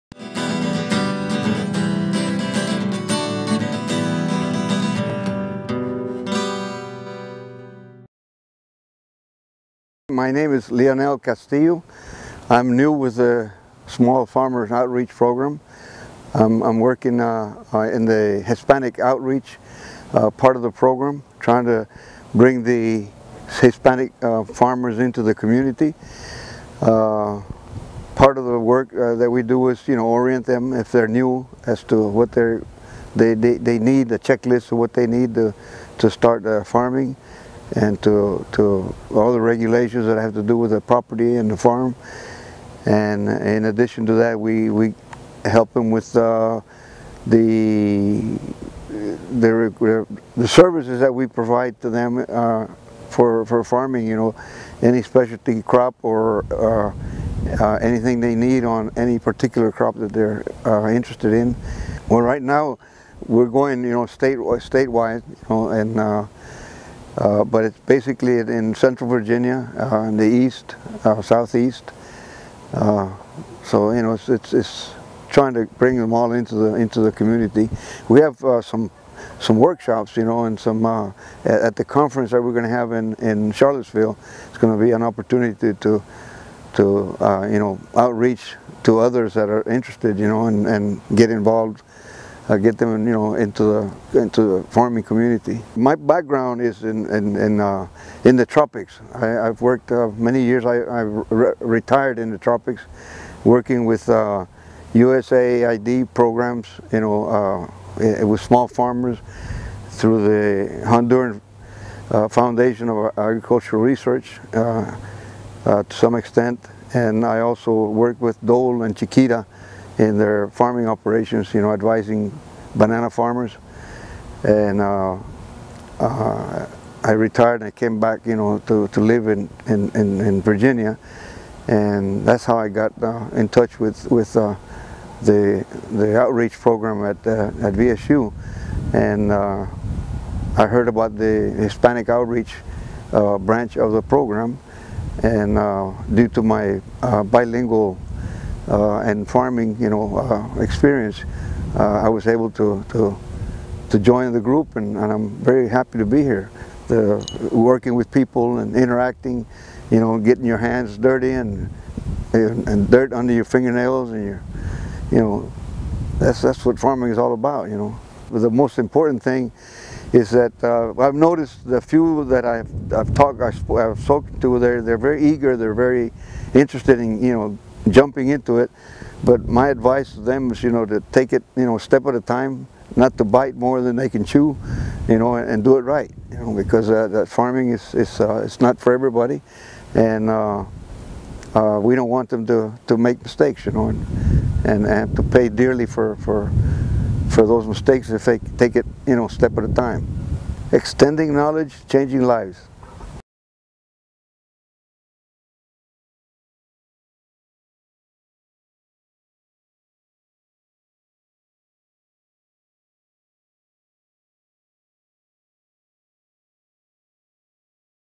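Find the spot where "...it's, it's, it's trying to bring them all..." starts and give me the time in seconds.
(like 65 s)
74 s.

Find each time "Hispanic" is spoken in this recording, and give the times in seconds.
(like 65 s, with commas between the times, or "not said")
18 s, 23 s, 141 s.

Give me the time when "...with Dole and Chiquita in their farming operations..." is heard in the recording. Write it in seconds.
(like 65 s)
118 s.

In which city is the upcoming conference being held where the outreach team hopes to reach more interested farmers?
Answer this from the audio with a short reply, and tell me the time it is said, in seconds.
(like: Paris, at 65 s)
Charlottesville, at 83 s.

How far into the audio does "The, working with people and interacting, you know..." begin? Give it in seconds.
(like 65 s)
156 s.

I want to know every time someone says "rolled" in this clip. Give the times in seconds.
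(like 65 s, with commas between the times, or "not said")
not said.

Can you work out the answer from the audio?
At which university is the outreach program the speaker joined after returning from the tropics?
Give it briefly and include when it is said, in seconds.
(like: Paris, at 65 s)
VSU, at 137 s.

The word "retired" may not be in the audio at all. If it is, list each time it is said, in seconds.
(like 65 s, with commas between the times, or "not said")
101 s, 127 s.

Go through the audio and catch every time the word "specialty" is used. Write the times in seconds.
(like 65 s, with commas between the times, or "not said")
55 s.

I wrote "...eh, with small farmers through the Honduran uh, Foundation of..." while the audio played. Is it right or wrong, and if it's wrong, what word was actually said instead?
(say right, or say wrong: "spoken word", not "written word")
right.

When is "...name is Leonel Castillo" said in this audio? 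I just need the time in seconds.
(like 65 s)
10 s.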